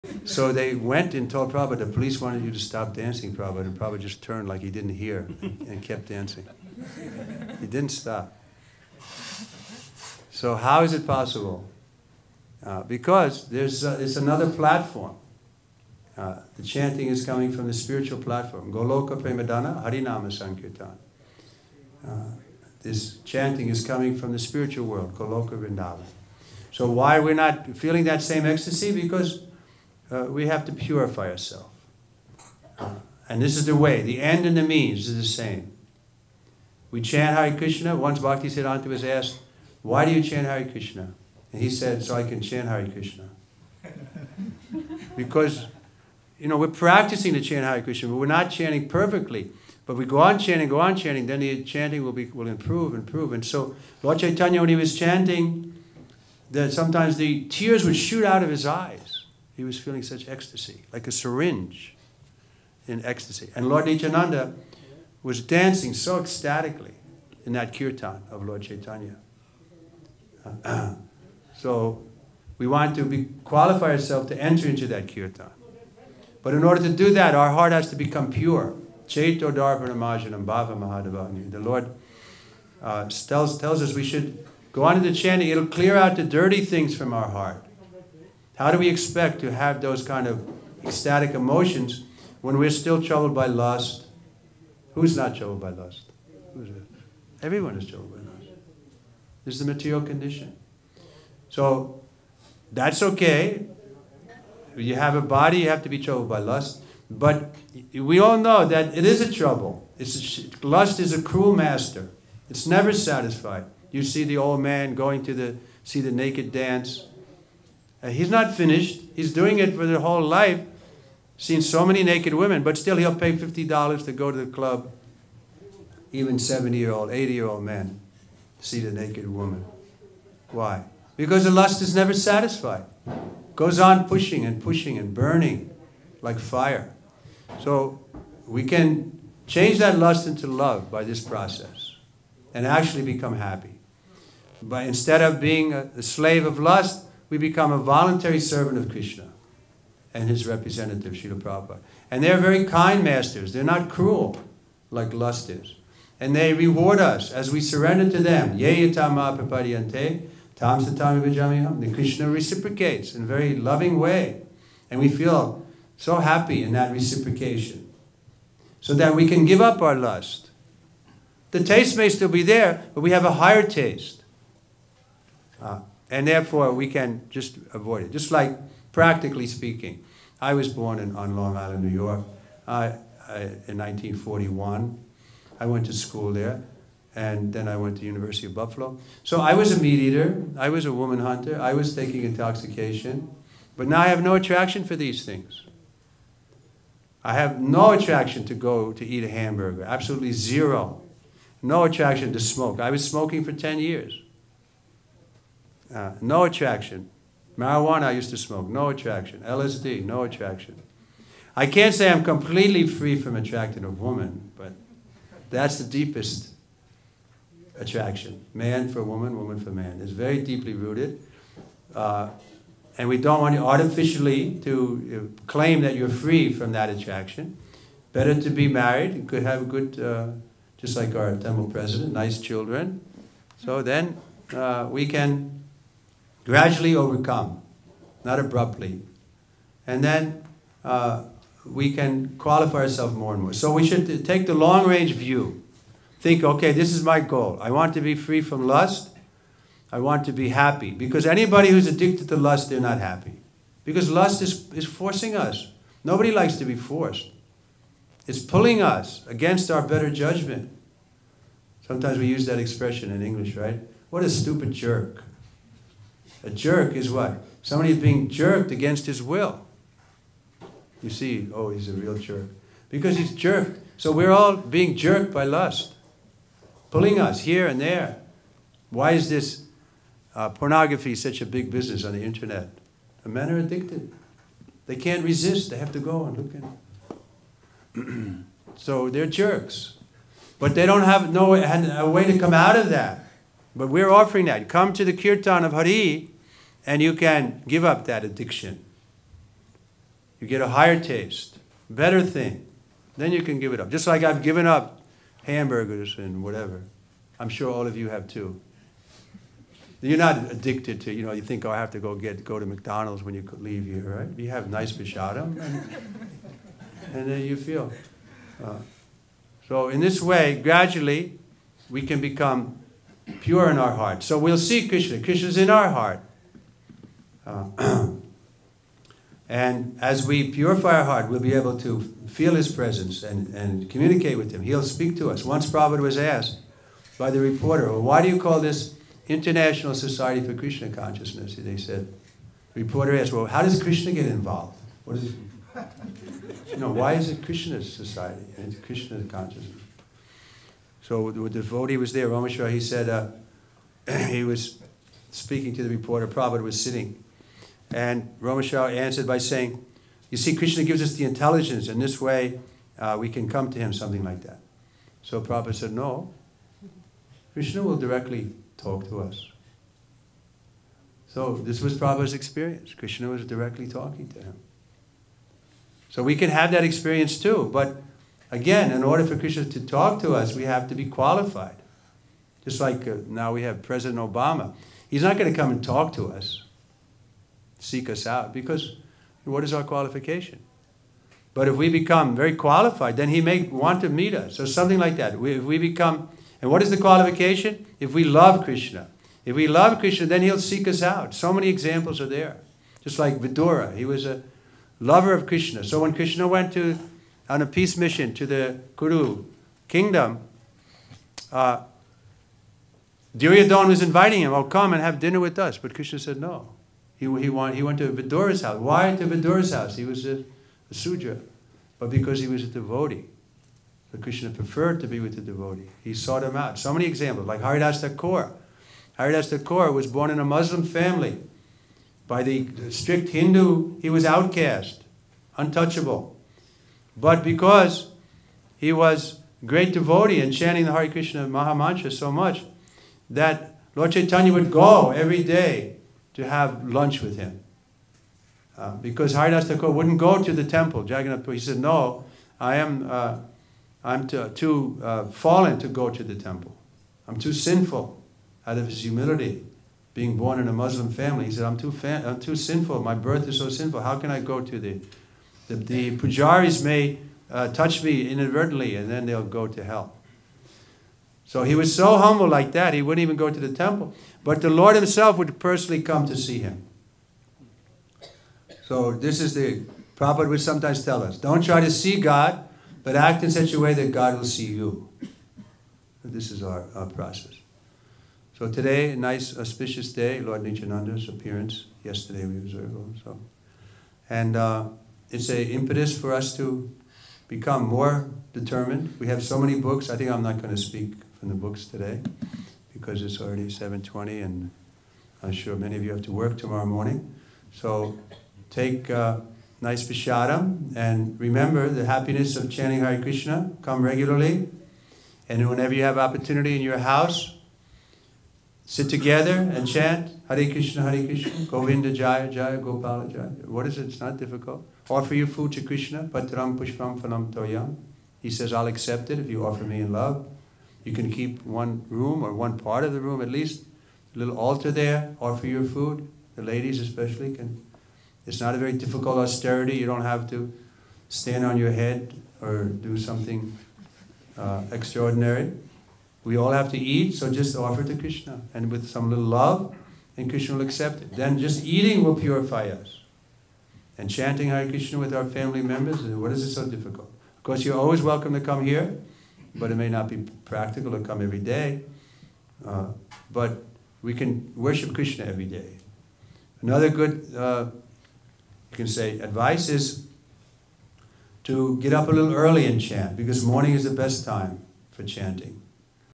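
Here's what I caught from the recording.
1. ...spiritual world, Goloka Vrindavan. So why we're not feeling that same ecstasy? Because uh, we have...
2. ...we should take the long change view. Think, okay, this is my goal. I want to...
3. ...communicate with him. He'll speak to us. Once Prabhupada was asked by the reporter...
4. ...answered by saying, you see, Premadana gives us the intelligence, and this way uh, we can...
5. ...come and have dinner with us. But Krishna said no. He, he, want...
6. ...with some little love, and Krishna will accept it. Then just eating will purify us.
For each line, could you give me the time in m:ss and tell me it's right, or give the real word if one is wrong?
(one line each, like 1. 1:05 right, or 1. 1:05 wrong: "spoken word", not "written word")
1. 0:24 right
2. 4:03 wrong: "range", not "change"
3. 5:33 right
4. 5:58 wrong: "Krishna", not "Premadana"
5. 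6:54 right
6. 9:08 right.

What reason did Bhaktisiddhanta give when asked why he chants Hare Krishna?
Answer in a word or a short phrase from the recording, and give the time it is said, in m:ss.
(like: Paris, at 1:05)
So I can chant Hare Krishna, at 0:42.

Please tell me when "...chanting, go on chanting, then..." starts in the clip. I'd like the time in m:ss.
0:50.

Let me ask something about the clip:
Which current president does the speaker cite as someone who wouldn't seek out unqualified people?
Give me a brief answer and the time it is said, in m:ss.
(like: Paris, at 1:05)
Obama, at 6:24.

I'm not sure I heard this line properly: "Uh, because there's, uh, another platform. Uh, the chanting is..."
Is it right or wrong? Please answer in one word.
right.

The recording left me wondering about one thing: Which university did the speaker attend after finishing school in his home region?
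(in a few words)
University of Buffalo.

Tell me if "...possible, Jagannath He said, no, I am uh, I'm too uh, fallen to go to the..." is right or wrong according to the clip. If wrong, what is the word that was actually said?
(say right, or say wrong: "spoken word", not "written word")
wrong: "temple", not "possible".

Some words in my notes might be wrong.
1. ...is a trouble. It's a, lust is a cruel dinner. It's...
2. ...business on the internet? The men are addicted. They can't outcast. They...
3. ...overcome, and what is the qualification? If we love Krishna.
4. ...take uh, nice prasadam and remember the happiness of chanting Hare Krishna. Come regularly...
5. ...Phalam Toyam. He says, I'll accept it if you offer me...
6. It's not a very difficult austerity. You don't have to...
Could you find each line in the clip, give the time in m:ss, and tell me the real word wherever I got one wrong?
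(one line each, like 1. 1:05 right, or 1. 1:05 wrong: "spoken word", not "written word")
1. 1:49 wrong: "master", not "dinner"
2. 4:41 wrong: "resist", not "outcast"
3. 6:35 wrong: "become", not "overcome"
4. 8:28 right
5. 8:47 right
6. 8:58 right.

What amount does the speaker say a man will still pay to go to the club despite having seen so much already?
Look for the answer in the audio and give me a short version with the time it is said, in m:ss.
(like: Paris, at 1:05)
$50, at 2:03.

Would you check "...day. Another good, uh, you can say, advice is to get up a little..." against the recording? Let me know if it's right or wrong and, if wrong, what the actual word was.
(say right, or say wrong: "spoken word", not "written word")
right.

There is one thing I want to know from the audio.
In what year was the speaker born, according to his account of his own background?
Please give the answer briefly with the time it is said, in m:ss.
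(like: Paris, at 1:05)
1941, at 3:03.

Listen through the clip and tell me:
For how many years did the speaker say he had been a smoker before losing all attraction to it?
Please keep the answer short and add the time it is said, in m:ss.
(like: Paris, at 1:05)
10, at 3:23.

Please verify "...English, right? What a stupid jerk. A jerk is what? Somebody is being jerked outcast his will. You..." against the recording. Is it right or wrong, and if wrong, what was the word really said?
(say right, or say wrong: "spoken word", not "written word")
wrong: "against", not "outcast".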